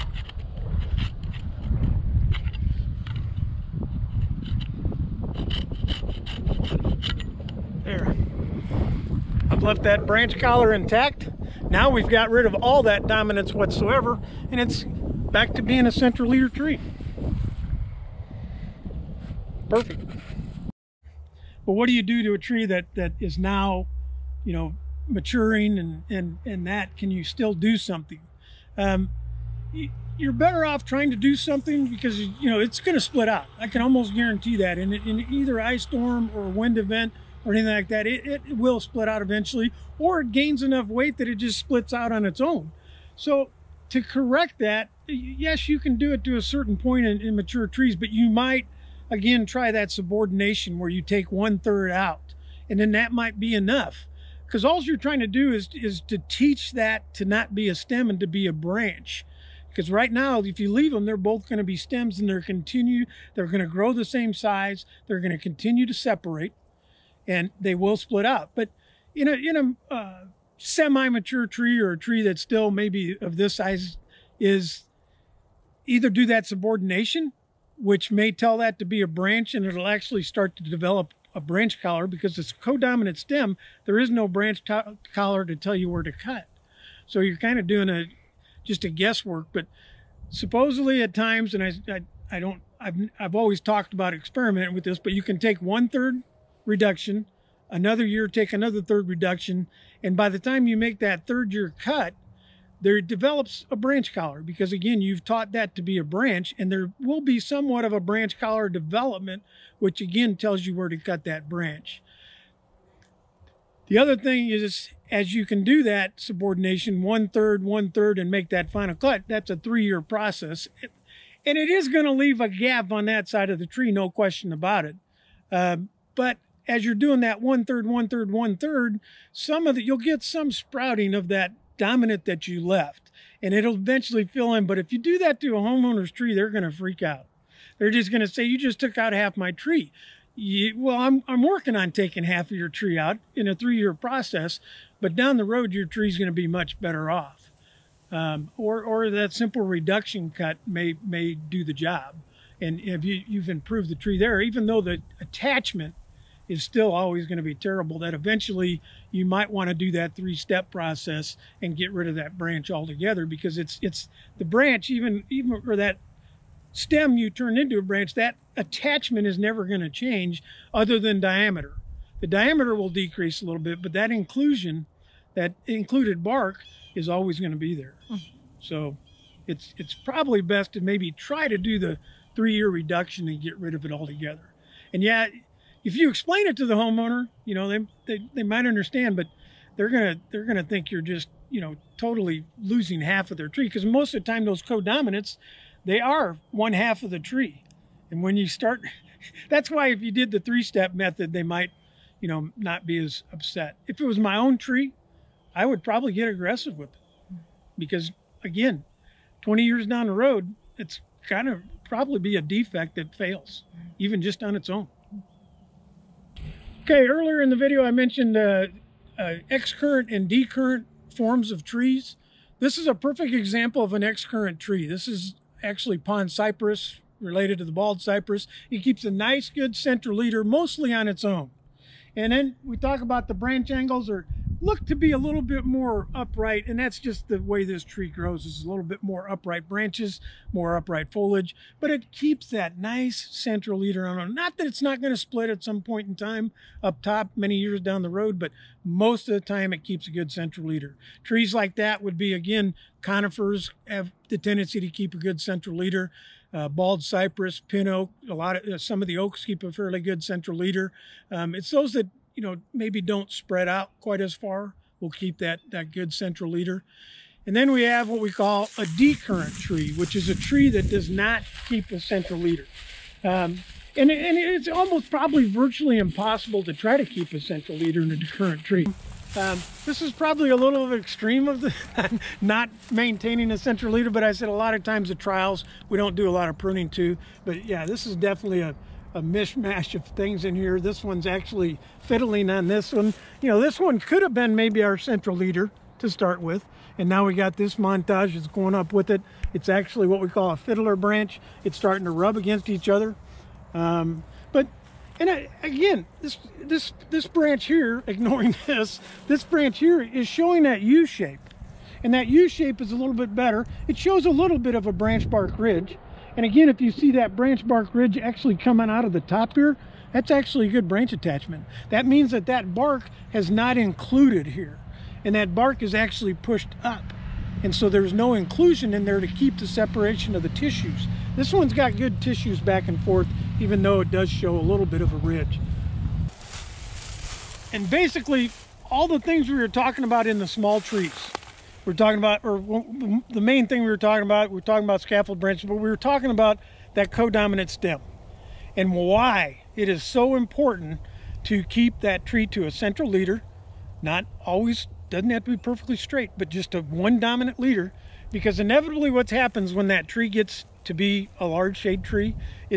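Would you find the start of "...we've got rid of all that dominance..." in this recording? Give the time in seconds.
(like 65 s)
11 s.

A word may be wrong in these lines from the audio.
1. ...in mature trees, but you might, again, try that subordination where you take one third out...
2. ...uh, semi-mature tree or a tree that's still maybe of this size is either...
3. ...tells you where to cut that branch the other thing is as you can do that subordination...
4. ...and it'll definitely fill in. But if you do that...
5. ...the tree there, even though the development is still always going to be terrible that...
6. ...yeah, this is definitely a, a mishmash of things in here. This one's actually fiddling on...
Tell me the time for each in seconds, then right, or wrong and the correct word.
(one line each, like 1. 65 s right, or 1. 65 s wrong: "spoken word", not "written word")
1. 47 s right
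2. 69 s right
3. 110 s right
4. 133 s wrong: "eventually", not "definitely"
5. 153 s wrong: "attachment", not "development"
6. 287 s right.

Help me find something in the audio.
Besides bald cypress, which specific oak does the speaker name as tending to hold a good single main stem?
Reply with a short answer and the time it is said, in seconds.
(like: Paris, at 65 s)
pin oak, at 257 s.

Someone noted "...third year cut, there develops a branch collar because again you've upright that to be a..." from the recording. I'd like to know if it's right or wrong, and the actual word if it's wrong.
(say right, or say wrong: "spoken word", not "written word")
wrong: "taught", not "upright".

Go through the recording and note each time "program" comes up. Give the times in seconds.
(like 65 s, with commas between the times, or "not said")
not said.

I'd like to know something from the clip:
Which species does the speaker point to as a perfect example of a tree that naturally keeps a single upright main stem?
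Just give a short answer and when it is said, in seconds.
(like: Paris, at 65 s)
pond cypress, at 225 s.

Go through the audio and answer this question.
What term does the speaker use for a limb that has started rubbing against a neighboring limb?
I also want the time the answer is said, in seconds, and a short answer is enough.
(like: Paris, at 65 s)
fiddler branch, at 300 s.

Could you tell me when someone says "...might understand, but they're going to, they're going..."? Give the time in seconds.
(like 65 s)
188 s.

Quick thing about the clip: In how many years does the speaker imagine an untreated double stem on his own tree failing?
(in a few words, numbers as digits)
20.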